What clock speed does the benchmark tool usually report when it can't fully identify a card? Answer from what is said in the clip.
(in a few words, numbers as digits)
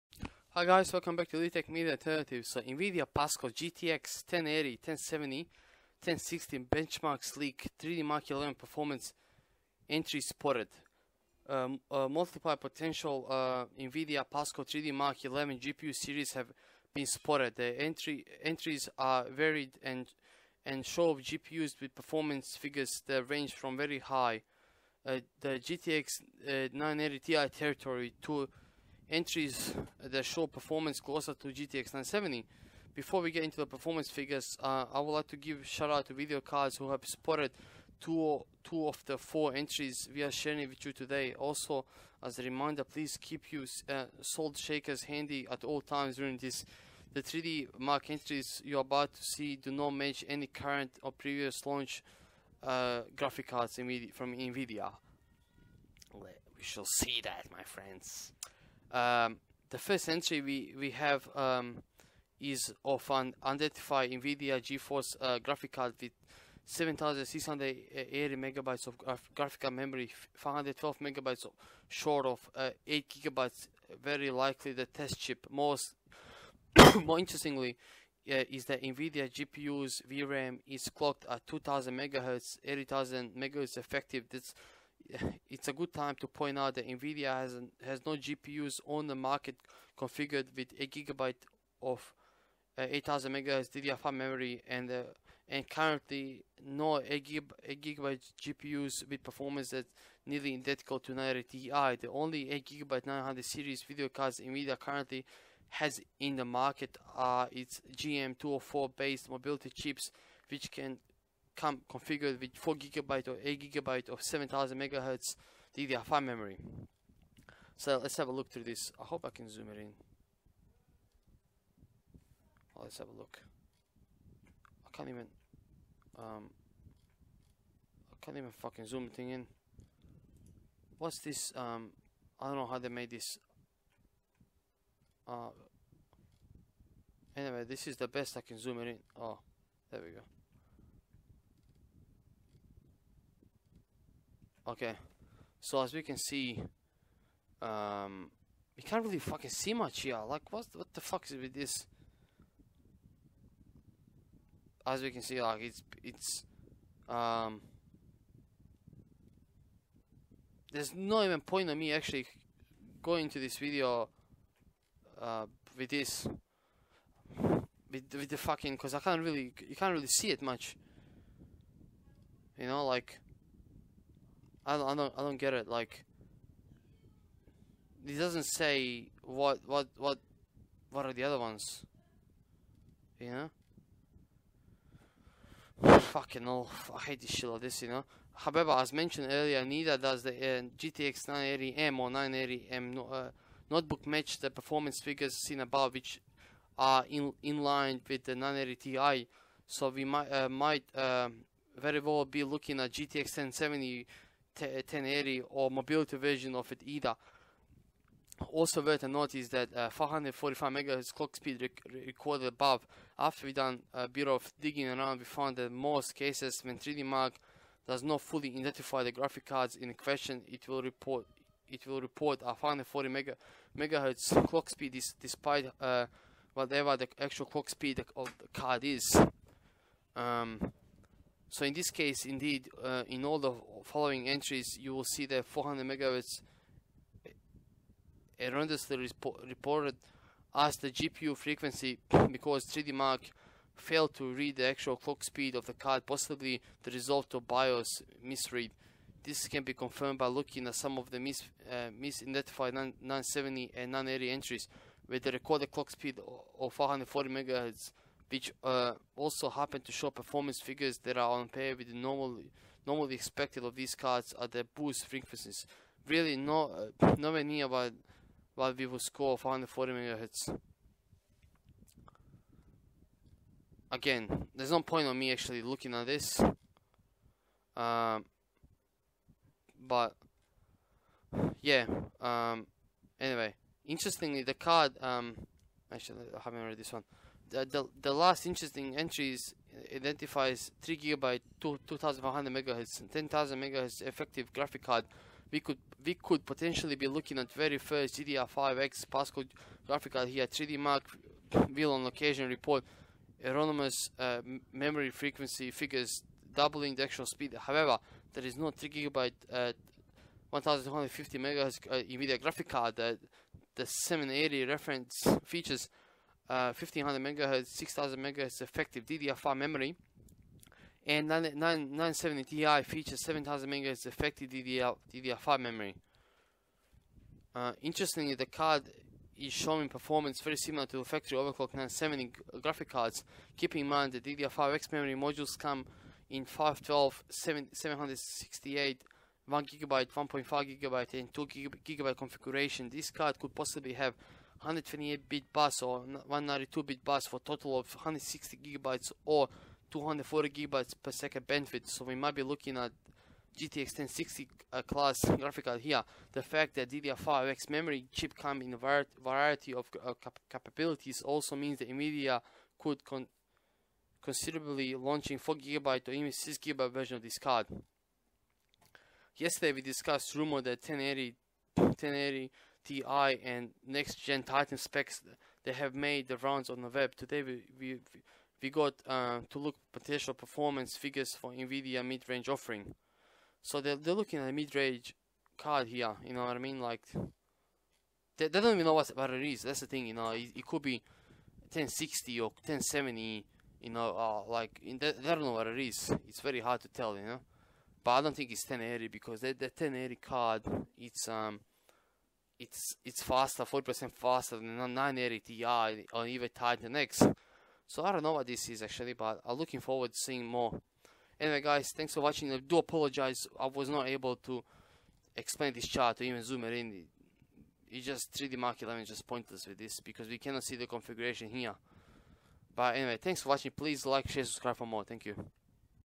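540 MHz.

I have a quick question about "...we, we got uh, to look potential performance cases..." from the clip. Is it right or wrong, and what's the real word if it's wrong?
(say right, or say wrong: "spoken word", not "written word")
wrong: "figures", not "cases".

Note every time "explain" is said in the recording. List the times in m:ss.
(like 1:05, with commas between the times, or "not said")
6:55.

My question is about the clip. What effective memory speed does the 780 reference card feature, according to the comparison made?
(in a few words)
6000 MHz.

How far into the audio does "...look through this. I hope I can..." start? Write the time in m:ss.
1:58.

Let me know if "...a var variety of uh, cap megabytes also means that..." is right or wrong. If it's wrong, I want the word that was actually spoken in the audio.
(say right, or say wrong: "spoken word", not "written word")
wrong: "capabilities", not "megabytes".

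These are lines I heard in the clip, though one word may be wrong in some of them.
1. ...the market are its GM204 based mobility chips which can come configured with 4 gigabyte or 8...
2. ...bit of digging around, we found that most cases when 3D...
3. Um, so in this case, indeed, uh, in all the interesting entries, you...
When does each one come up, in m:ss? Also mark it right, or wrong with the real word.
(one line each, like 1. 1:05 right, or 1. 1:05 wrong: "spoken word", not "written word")
1. 1:46 right
2. 3:34 right
3. 3:50 wrong: "following", not "interesting".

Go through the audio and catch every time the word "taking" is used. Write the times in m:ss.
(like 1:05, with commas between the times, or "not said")
not said.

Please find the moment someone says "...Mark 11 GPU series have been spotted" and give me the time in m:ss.
0:14.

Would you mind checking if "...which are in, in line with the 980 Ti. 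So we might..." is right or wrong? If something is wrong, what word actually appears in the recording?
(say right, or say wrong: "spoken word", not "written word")
right.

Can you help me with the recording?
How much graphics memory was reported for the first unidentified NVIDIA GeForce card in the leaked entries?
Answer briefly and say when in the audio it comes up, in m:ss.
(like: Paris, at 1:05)
7680 megabytes, at 1:06.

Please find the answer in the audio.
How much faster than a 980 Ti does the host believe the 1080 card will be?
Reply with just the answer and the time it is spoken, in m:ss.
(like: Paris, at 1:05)
40%, at 6:43.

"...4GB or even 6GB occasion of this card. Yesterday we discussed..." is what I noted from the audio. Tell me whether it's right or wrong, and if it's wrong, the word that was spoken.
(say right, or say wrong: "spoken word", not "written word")
wrong: "version", not "occasion".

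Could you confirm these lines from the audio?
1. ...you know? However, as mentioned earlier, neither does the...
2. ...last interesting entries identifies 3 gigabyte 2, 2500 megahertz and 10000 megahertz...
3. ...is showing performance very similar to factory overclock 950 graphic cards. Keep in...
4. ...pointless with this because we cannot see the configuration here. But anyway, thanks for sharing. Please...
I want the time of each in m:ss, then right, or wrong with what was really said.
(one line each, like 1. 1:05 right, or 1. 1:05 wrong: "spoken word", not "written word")
1. 3:07 right
2. 4:48 right
3. 5:29 wrong: "970", not "950"
4. 6:59 wrong: "watching", not "sharing".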